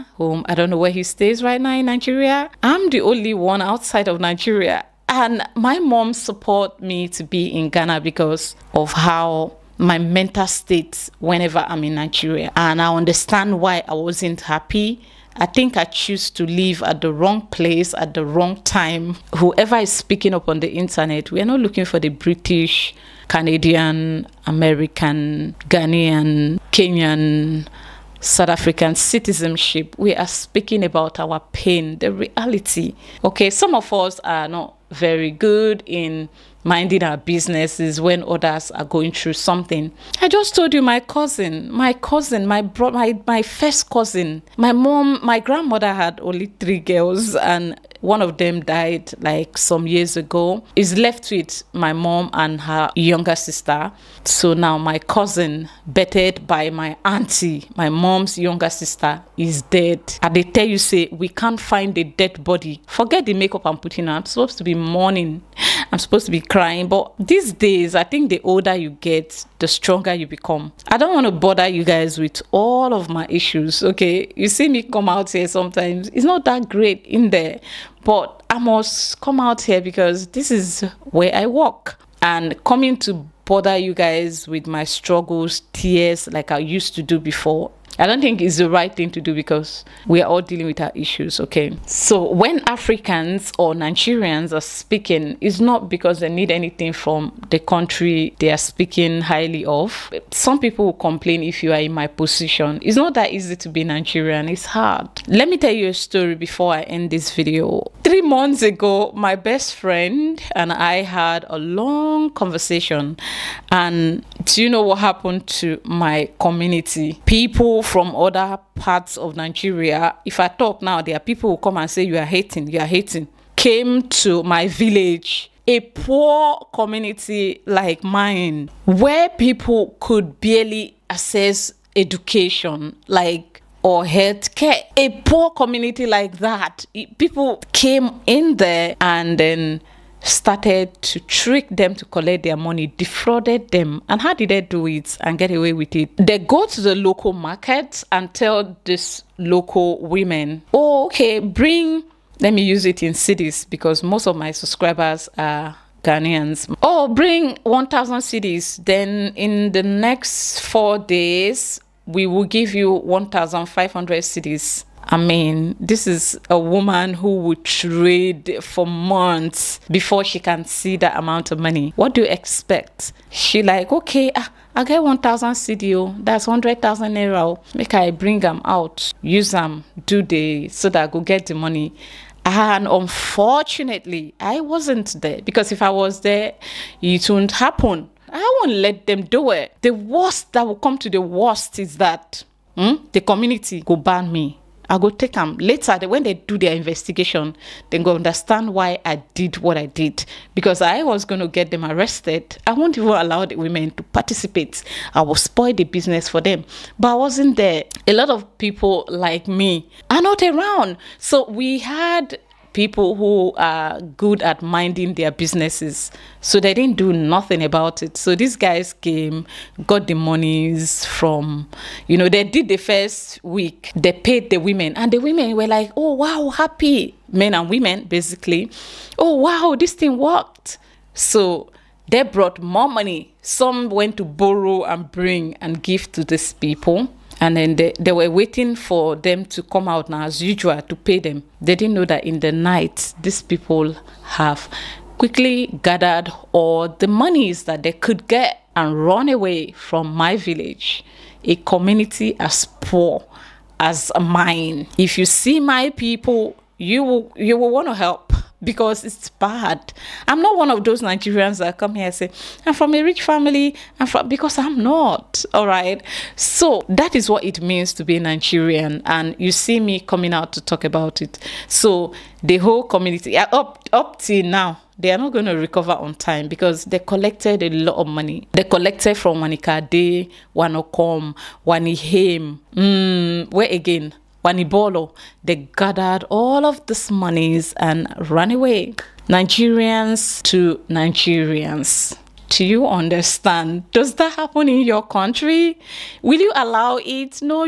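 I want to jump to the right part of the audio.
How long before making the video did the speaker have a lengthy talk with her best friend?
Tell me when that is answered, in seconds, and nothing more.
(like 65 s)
108 s.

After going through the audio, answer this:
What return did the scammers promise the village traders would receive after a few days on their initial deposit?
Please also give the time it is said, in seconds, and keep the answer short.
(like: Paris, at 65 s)
1,500 cedis, at 162 s.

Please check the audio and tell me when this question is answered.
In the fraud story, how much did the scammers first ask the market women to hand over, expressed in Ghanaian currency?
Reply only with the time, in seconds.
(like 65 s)
157 s.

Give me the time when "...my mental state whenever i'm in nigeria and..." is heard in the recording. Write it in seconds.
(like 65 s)
9 s.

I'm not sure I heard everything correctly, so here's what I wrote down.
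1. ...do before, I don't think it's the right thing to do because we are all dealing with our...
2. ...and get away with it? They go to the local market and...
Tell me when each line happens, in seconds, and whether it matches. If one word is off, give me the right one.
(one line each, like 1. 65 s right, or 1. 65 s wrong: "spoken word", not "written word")
1. 87 s right
2. 145 s right.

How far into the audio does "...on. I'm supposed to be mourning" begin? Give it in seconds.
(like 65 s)
64 s.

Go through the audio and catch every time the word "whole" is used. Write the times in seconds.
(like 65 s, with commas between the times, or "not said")
272 s.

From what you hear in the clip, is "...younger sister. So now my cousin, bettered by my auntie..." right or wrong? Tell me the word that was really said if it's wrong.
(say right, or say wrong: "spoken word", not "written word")
right.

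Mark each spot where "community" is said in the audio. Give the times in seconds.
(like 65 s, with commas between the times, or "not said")
116 s, 126 s, 135 s, 193 s, 251 s, 272 s.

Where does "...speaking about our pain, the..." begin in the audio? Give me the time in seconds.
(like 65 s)
30 s.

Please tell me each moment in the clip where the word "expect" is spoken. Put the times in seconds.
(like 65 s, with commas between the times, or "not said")
172 s.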